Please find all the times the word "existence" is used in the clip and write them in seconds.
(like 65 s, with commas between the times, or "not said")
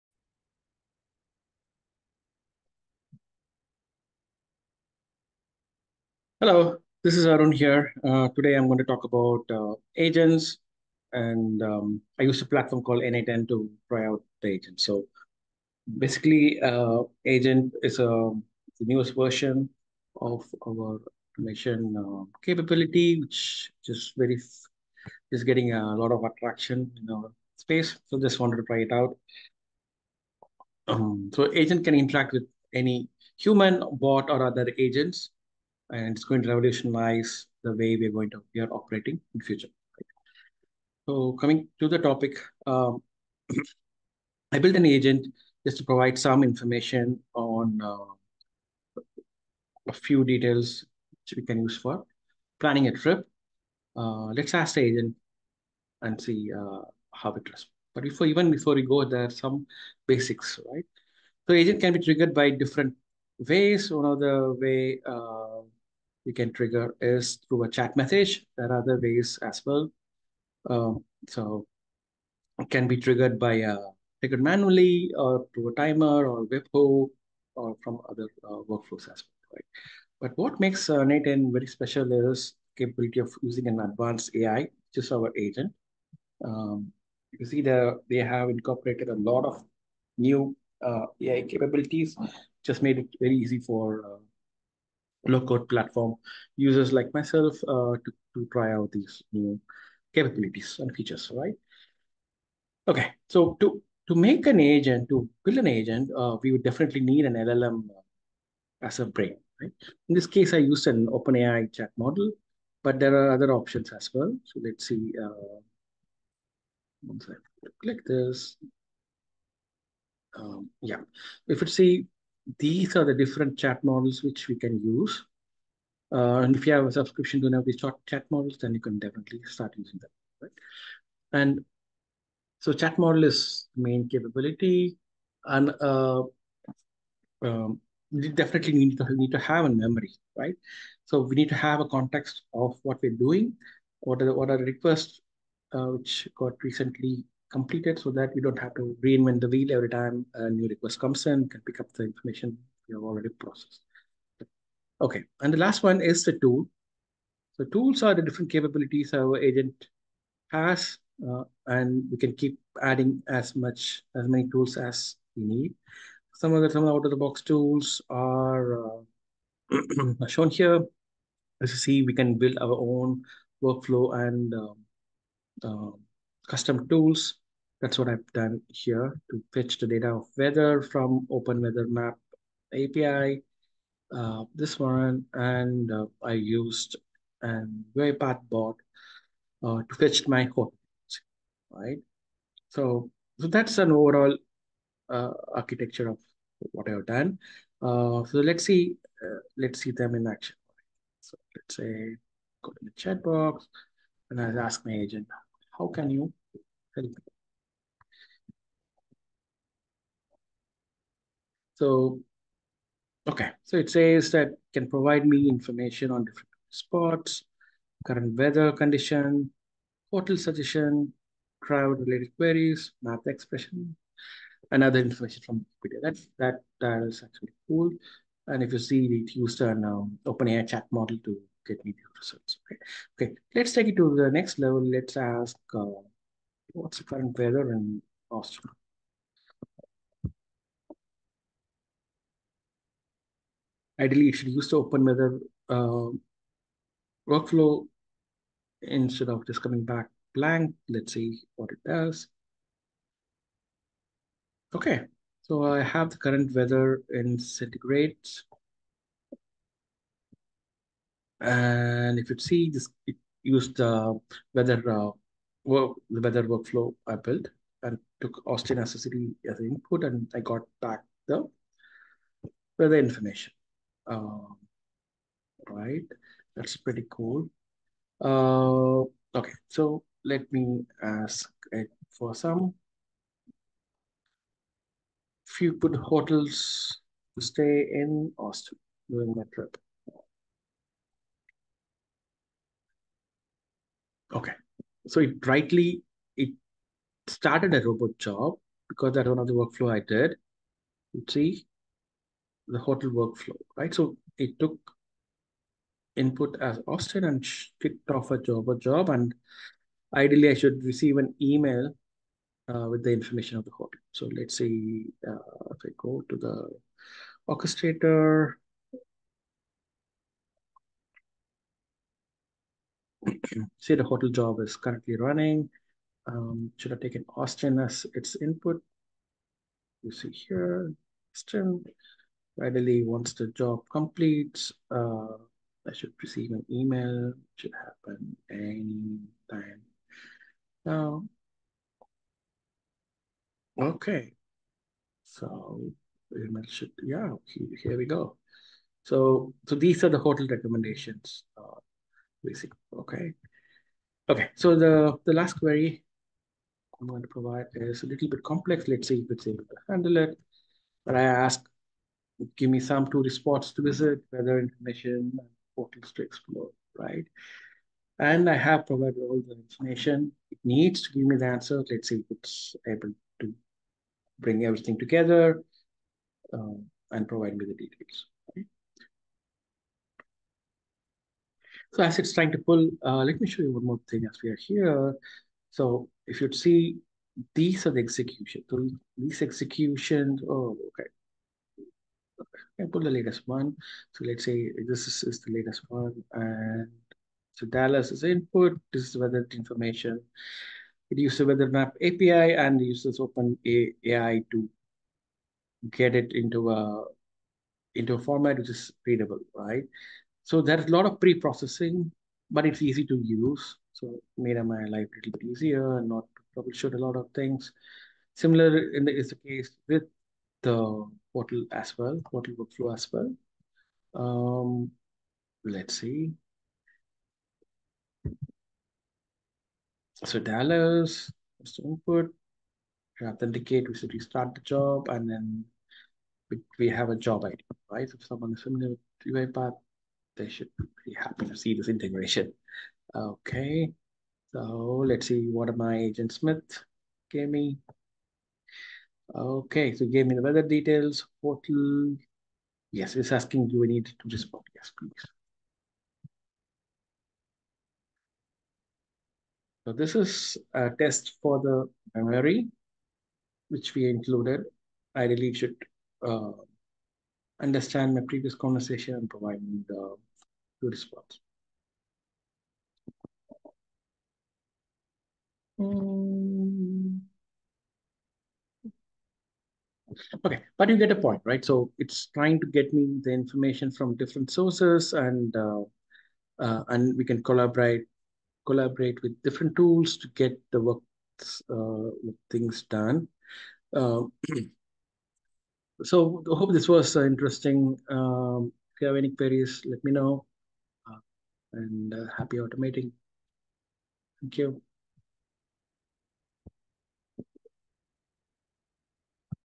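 not said.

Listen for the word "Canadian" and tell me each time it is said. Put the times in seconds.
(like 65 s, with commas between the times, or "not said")
not said.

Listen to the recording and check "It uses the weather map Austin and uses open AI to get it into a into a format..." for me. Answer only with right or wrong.
wrong.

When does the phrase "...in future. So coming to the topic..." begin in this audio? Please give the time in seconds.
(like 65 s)
39 s.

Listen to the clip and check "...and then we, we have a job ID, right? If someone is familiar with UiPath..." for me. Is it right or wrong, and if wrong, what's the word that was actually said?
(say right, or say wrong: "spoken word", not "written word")
right.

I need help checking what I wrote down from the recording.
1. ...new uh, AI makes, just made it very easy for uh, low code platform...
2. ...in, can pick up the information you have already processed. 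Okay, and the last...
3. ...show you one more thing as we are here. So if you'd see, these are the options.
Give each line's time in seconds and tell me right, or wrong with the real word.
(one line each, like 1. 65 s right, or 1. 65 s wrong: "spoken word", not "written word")
1. 90 s wrong: "capabilities", not "makes"
2. 151 s right
3. 383 s wrong: "executions", not "options".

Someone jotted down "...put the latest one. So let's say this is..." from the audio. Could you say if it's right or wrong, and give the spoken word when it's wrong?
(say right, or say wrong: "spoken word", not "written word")
right.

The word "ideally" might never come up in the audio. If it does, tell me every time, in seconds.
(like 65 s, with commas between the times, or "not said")
244 s, 310 s.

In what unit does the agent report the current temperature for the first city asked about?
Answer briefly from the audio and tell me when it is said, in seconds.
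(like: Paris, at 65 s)
Centigrade, at 257 s.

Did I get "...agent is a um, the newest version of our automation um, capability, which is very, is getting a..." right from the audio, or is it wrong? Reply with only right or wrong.
right.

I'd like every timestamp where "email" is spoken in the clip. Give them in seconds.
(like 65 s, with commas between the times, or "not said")
311 s, 336 s, 346 s.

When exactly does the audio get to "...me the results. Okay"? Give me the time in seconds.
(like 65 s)
231 s.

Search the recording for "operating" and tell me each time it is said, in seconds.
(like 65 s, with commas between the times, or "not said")
38 s.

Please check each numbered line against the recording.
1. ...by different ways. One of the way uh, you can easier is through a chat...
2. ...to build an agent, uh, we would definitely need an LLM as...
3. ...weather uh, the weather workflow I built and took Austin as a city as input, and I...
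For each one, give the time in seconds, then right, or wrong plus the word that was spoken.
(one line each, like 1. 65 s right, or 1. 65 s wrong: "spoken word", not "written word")
1. 62 s wrong: "trigger", not "easier"
2. 105 s right
3. 264 s right.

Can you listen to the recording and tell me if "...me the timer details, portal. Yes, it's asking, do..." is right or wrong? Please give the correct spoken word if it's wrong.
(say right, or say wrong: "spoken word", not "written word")
wrong: "weather", not "timer".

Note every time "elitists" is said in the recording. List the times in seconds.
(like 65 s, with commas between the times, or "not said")
not said.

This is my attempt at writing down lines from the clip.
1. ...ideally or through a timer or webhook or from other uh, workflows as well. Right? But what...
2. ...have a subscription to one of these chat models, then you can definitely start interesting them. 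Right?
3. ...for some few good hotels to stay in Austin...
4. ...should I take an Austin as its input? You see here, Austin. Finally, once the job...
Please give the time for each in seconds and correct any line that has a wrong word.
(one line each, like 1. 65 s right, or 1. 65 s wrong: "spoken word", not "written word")
1. 74 s wrong: "manually", not "ideally"
2. 126 s wrong: "using", not "interesting"
3. 282 s right
4. 326 s right.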